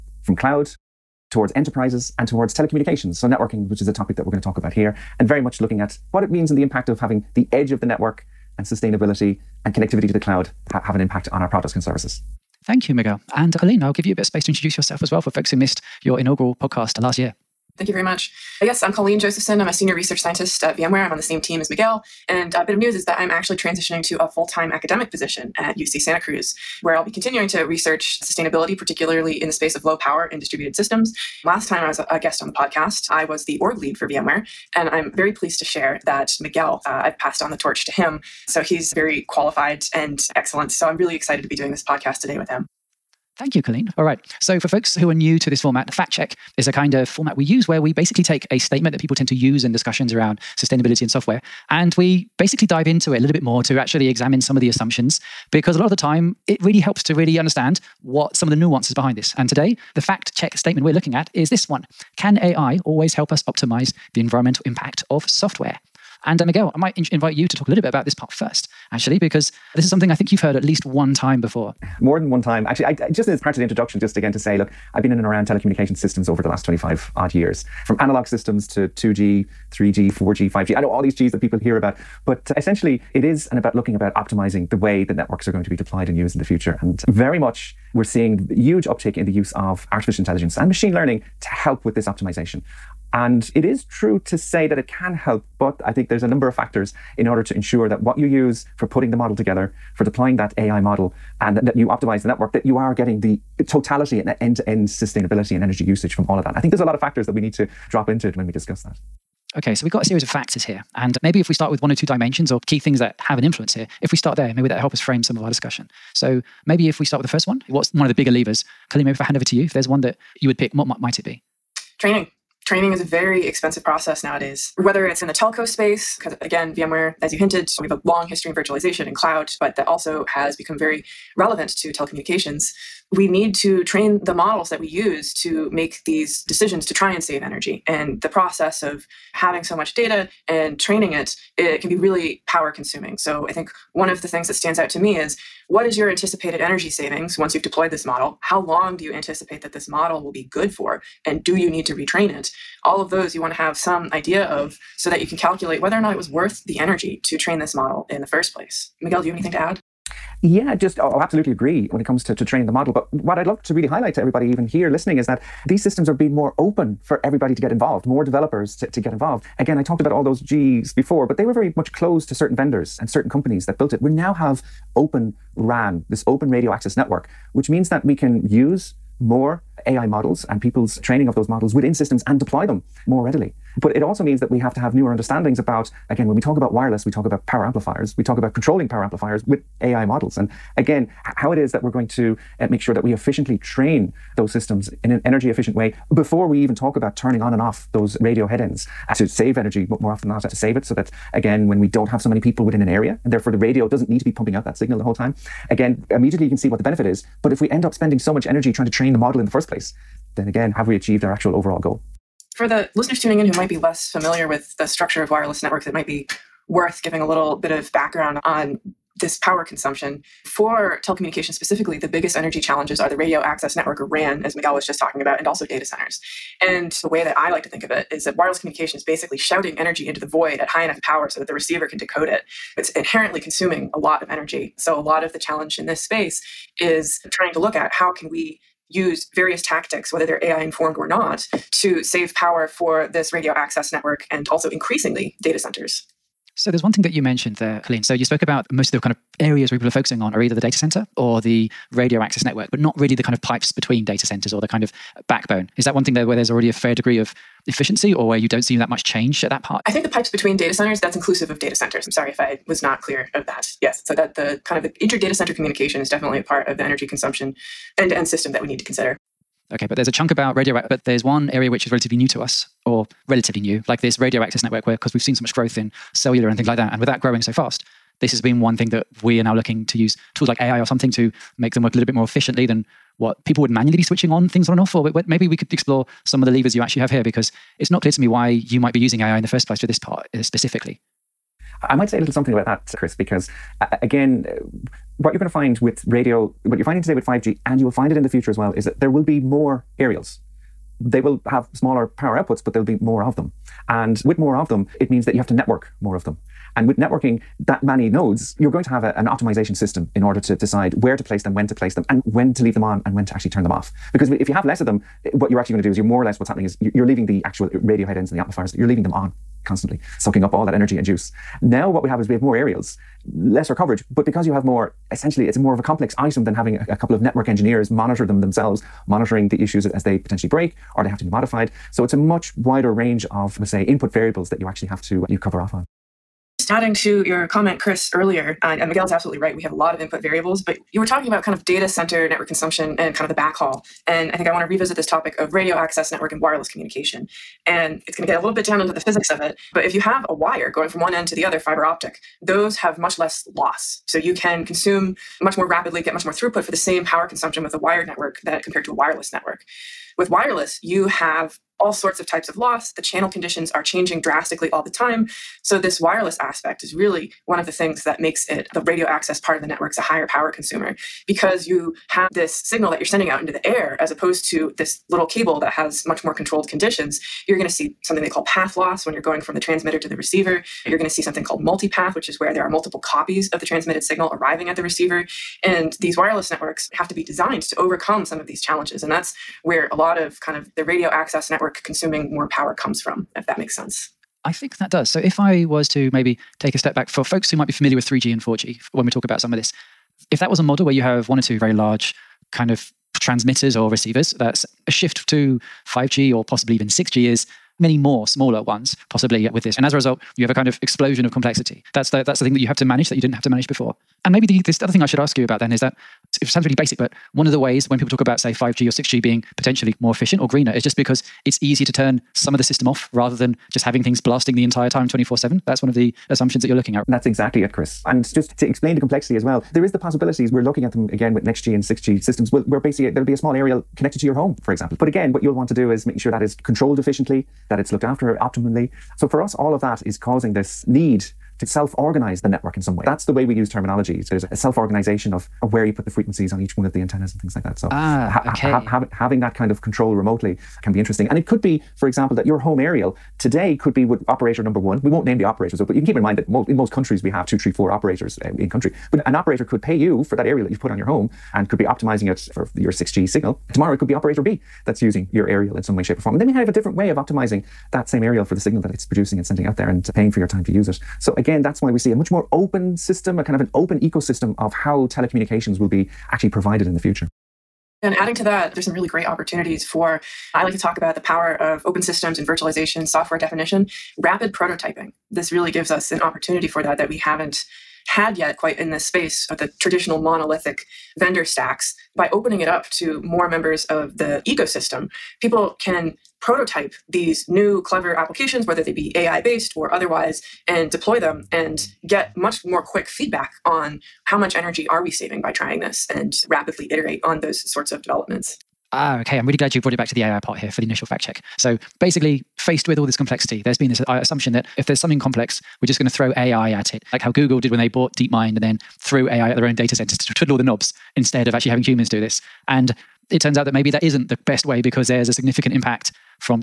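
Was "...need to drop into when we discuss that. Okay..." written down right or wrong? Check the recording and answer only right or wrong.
right.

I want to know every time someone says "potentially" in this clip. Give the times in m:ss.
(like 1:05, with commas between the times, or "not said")
5:30, 6:59.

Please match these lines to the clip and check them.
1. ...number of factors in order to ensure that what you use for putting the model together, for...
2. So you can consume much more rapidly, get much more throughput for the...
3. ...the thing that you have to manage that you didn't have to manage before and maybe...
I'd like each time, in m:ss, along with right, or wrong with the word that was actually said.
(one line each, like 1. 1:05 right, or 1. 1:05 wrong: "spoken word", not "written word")
1. 1:36 right
2. 5:54 right
3. 6:52 right.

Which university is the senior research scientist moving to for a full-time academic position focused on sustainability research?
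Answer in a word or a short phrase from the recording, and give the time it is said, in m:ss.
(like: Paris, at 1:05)
UC Santa Cruz, at 0:25.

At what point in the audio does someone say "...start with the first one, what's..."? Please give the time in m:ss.
1:57.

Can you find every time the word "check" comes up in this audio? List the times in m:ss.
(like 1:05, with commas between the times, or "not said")
0:46, 1:00, 8:31.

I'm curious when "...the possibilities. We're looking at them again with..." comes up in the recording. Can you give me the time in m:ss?
7:09.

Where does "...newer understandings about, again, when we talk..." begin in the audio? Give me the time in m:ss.
3:04.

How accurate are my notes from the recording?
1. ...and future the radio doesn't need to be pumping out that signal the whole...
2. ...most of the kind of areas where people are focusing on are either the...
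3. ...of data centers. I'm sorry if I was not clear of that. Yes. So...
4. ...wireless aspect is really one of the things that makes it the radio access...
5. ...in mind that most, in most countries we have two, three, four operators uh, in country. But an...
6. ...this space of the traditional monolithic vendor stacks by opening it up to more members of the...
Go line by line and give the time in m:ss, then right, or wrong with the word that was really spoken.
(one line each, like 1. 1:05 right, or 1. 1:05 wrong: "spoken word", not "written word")
1. 3:23 wrong: "therefore", not "future"
2. 4:08 right
3. 4:21 right
4. 6:05 right
5. 7:36 right
6. 8:08 right.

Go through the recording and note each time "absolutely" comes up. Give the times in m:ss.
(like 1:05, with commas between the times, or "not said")
2:41, 5:39.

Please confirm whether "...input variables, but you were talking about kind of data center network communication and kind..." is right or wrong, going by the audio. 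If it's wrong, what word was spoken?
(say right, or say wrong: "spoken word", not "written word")
wrong: "consumption", not "communication".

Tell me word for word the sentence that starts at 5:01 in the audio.
They will have smaller power outputs, but there'll be more of them.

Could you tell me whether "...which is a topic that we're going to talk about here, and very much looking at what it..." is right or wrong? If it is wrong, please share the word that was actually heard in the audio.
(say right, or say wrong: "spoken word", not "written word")
right.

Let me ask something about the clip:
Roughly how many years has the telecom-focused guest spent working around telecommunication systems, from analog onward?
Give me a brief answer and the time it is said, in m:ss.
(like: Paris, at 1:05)
25, at 1:16.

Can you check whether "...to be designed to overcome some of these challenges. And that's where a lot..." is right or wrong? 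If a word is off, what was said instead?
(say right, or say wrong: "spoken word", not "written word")
right.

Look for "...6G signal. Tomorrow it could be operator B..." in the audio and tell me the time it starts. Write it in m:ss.
7:42.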